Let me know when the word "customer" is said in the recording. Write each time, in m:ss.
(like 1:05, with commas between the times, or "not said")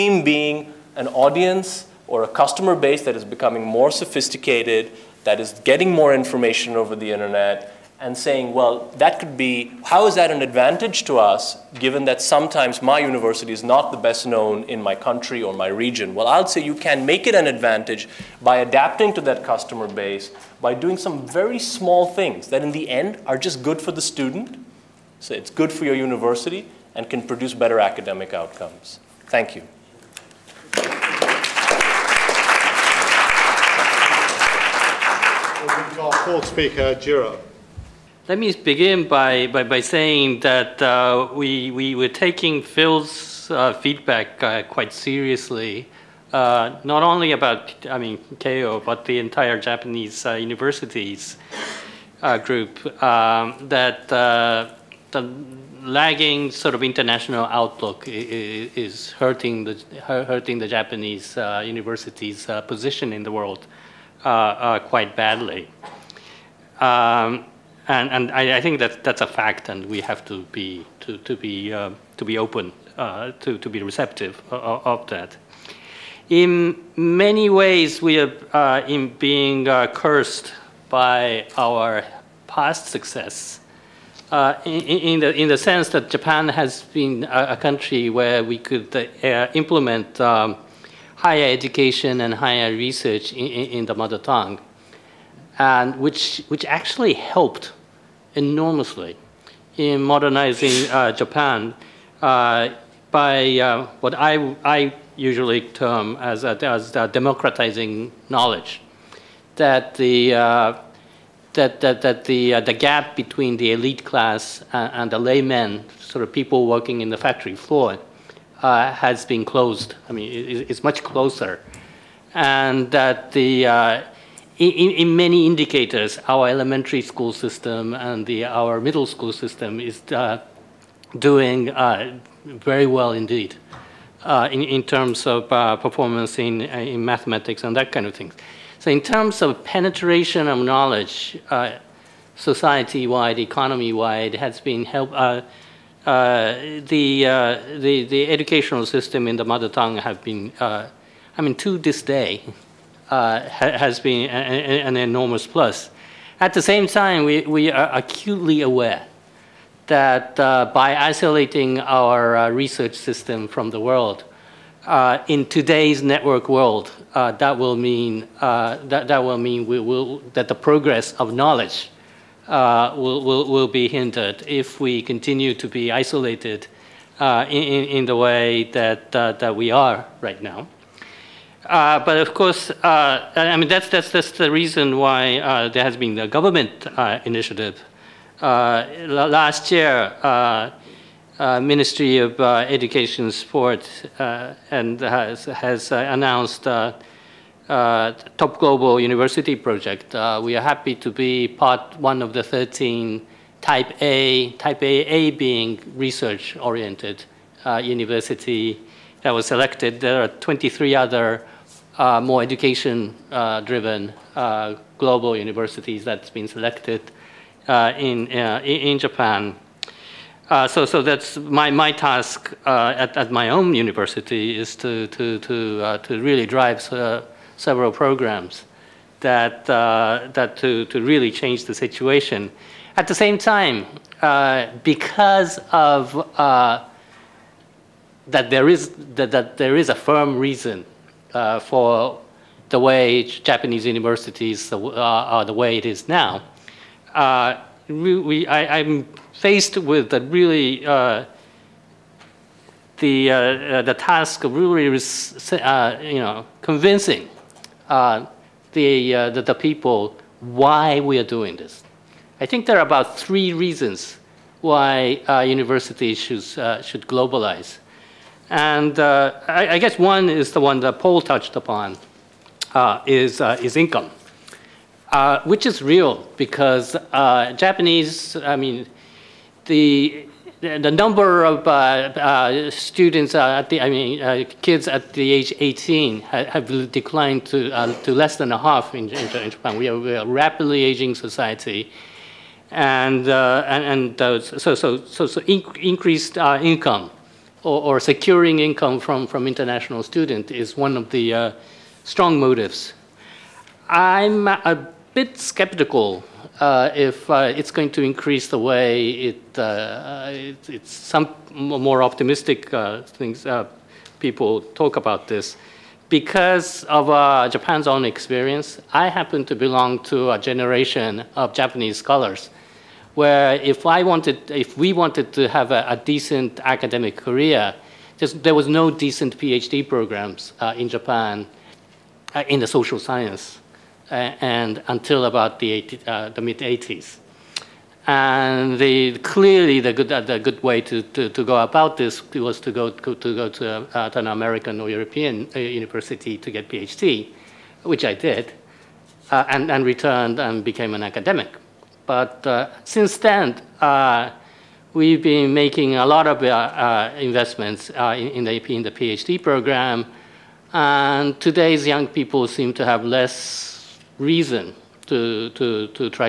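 0:02, 0:19.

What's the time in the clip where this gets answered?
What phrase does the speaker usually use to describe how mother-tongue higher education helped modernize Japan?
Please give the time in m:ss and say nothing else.
1:46.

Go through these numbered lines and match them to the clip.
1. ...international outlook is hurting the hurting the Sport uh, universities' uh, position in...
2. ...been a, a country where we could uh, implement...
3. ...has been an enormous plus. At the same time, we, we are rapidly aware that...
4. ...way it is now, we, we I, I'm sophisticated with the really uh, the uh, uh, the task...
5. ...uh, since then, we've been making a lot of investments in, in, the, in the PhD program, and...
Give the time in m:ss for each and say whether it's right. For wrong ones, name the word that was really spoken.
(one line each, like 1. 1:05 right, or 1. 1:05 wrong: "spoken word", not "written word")
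1. 0:56 wrong: "Japanese", not "Sport"
2. 1:26 right
3. 2:33 wrong: "acutely", not "rapidly"
4. 4:05 wrong: "faced", not "sophisticated"
5. 5:52 right.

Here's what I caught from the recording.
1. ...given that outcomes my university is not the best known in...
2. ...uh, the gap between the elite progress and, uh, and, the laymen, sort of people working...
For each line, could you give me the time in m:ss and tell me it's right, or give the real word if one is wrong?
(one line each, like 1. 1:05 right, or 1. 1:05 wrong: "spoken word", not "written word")
1. 0:11 wrong: "sometimes", not "outcomes"
2. 1:52 wrong: "class", not "progress".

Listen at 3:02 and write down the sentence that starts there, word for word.
but of course, I mean that's that's that's the reason why there has been the government initiative.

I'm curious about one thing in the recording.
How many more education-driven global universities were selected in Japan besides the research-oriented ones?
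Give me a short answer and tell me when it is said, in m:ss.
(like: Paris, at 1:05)
23, at 3:30.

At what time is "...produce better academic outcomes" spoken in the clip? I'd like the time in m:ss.
0:27.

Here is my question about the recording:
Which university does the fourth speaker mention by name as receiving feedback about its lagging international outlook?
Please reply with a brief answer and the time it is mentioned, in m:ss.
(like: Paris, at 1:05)
Keio, at 0:48.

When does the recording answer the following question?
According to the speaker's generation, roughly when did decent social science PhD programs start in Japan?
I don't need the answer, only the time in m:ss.
5:36.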